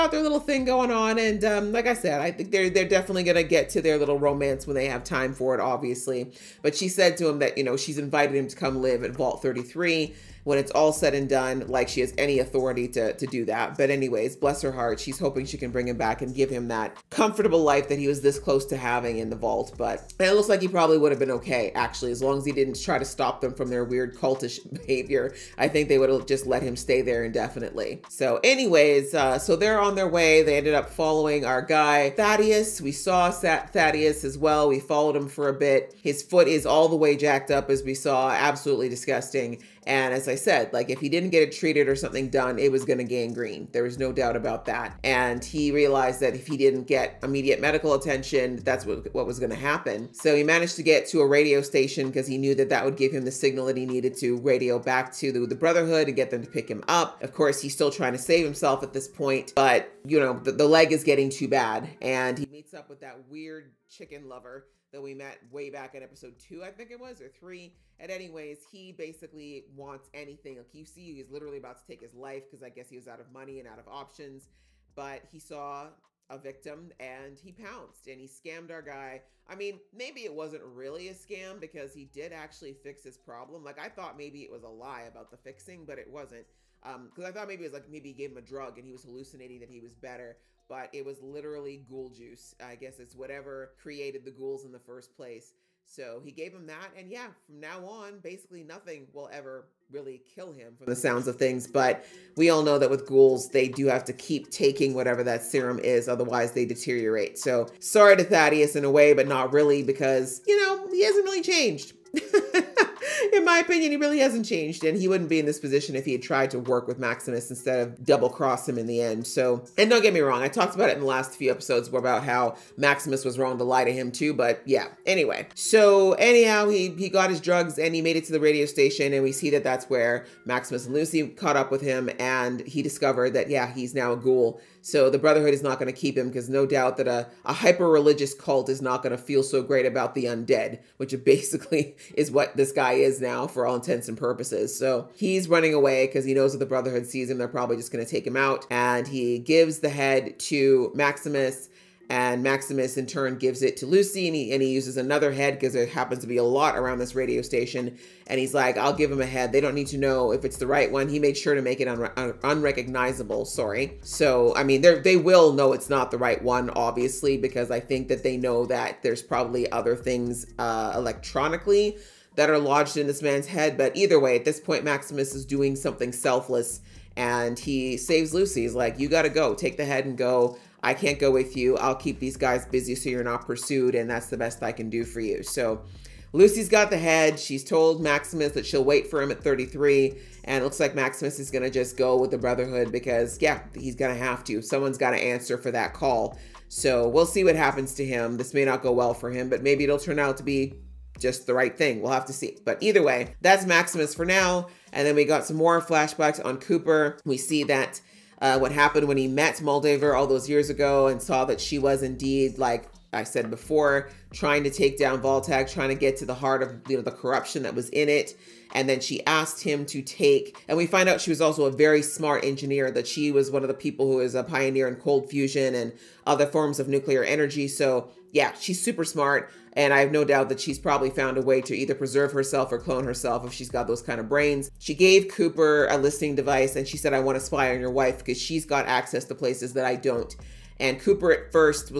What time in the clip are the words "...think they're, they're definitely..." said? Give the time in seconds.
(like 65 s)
2 s.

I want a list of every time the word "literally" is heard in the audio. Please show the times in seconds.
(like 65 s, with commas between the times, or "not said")
71 s, 91 s.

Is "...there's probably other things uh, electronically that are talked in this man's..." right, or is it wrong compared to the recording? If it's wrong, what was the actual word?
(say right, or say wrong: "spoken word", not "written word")
wrong: "lodged", not "talked".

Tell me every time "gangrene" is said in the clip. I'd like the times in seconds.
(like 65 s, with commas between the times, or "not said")
43 s.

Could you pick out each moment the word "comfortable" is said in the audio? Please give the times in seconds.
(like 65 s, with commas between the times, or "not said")
17 s.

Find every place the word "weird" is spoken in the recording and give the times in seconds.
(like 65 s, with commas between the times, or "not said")
23 s, 63 s.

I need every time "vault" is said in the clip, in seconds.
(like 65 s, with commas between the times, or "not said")
9 s, 19 s, 215 s.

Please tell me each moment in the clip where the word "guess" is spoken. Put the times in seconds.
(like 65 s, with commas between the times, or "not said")
72 s, 92 s.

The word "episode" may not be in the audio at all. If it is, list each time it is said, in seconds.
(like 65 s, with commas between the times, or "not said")
66 s, 121 s.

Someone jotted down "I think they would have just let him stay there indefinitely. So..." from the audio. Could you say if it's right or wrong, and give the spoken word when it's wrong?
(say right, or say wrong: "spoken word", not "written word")
right.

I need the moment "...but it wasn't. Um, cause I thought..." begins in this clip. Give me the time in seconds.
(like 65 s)
85 s.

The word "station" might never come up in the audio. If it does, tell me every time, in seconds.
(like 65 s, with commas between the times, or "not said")
51 s, 128 s, 157 s.